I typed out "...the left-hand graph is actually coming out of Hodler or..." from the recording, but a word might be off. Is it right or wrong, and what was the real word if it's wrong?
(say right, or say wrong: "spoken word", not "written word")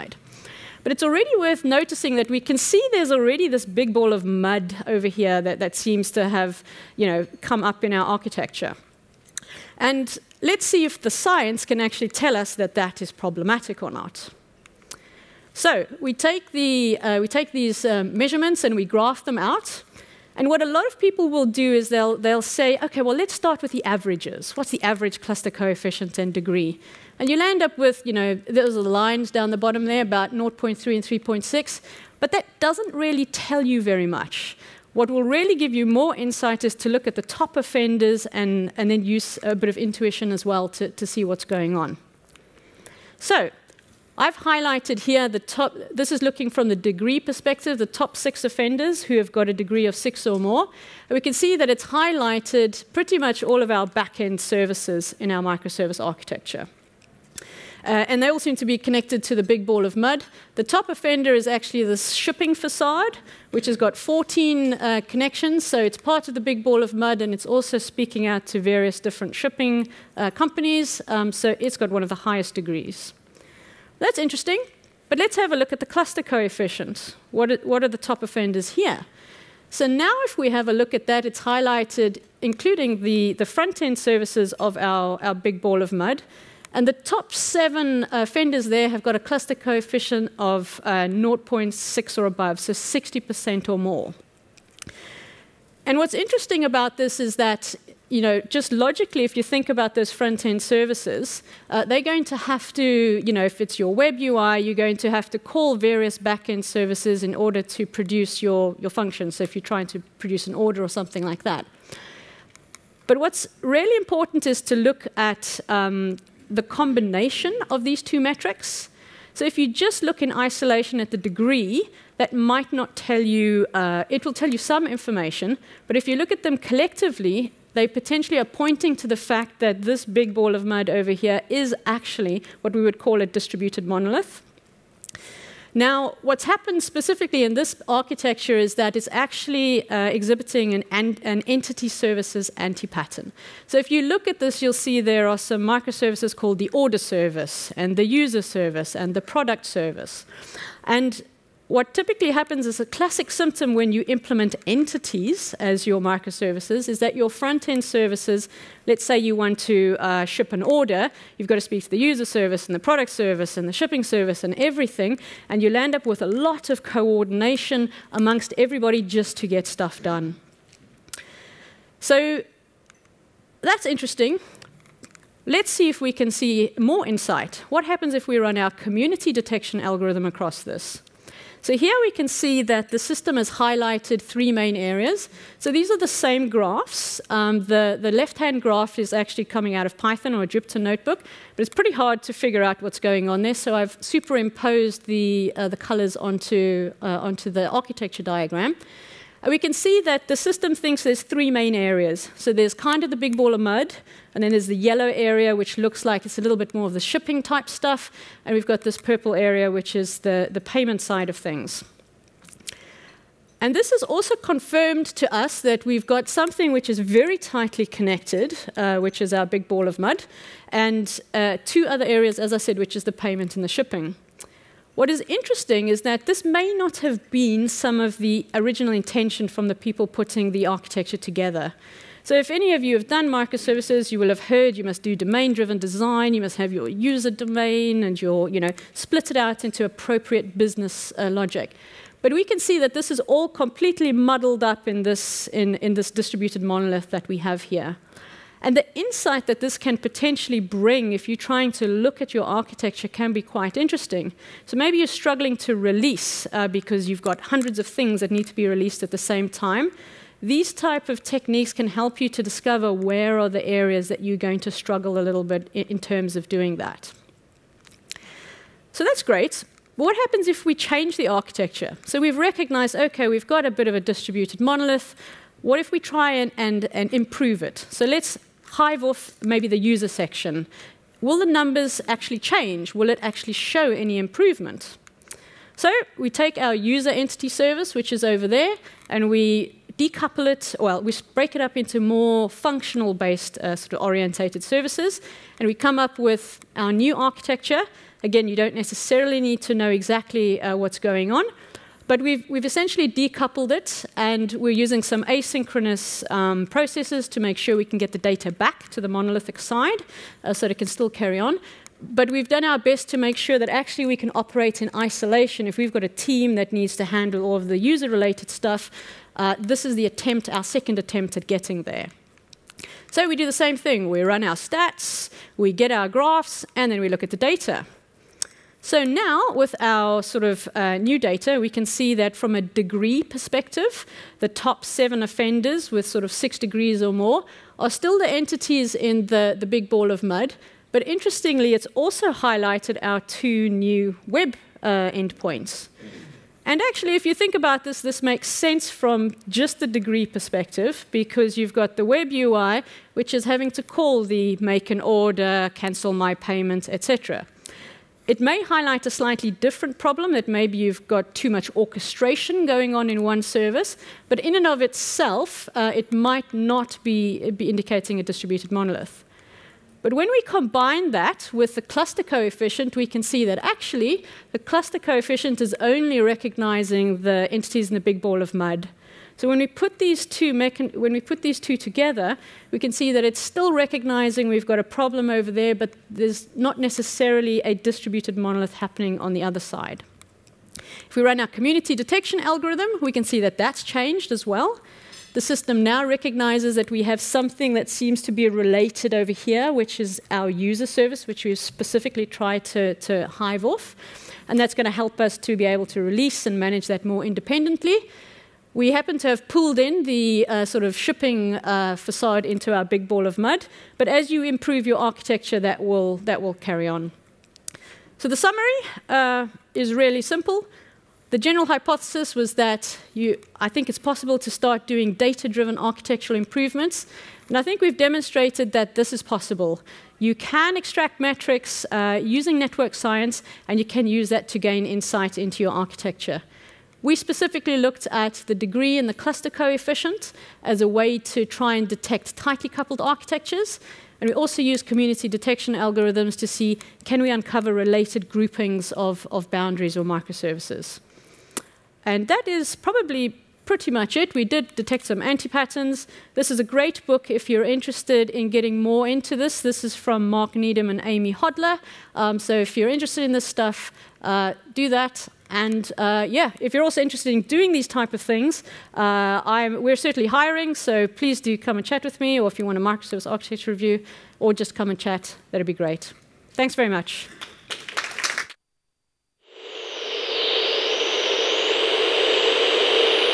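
wrong: "Python", not "Hodler".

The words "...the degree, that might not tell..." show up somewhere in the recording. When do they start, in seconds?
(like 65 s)
121 s.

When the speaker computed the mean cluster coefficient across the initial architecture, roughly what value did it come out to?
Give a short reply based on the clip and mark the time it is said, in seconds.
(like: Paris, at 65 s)
0.3, at 30 s.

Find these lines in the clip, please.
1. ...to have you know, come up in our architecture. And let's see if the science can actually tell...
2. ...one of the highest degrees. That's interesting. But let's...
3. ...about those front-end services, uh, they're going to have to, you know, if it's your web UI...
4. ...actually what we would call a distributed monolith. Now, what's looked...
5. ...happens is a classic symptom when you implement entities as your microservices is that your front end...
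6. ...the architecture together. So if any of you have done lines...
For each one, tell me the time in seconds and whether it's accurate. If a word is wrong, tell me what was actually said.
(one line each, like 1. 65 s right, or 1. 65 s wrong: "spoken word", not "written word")
1. 6 s right
2. 71 s right
3. 99 s right
4. 131 s wrong: "happened", not "looked"
5. 152 s right
6. 230 s wrong: "microservices", not "lines".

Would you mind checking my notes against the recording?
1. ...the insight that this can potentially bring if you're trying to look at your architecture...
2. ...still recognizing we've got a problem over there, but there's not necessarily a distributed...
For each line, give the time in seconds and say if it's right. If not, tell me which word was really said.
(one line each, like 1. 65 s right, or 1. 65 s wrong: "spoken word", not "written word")
1. 248 s right
2. 383 s right.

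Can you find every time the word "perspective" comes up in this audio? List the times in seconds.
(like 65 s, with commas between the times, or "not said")
47 s, 333 s, 350 s.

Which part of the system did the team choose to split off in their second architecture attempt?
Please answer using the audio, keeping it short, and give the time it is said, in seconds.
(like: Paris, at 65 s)
The user section, at 279 s.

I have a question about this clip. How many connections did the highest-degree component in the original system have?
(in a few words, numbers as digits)
14.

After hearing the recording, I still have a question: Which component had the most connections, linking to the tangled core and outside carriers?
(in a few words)
Shipping facade.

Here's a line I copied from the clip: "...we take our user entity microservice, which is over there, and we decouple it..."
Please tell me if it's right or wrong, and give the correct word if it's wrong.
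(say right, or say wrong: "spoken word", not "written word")
wrong: "service", not "microservice".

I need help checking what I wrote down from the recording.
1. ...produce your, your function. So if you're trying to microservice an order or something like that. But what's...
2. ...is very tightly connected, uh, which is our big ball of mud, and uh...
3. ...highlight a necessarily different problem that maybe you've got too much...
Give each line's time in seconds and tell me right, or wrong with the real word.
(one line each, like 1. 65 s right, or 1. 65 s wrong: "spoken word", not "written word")
1. 107 s wrong: "produce", not "microservice"
2. 216 s right
3. 358 s wrong: "slightly", not "necessarily".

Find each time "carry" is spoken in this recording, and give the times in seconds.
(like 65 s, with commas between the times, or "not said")
311 s, 416 s.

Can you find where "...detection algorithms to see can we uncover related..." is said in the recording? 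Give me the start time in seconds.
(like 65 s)
445 s.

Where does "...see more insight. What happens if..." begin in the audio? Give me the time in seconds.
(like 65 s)
176 s.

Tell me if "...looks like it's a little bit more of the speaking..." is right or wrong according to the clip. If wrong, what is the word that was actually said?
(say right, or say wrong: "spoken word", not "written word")
wrong: "shipping", not "speaking".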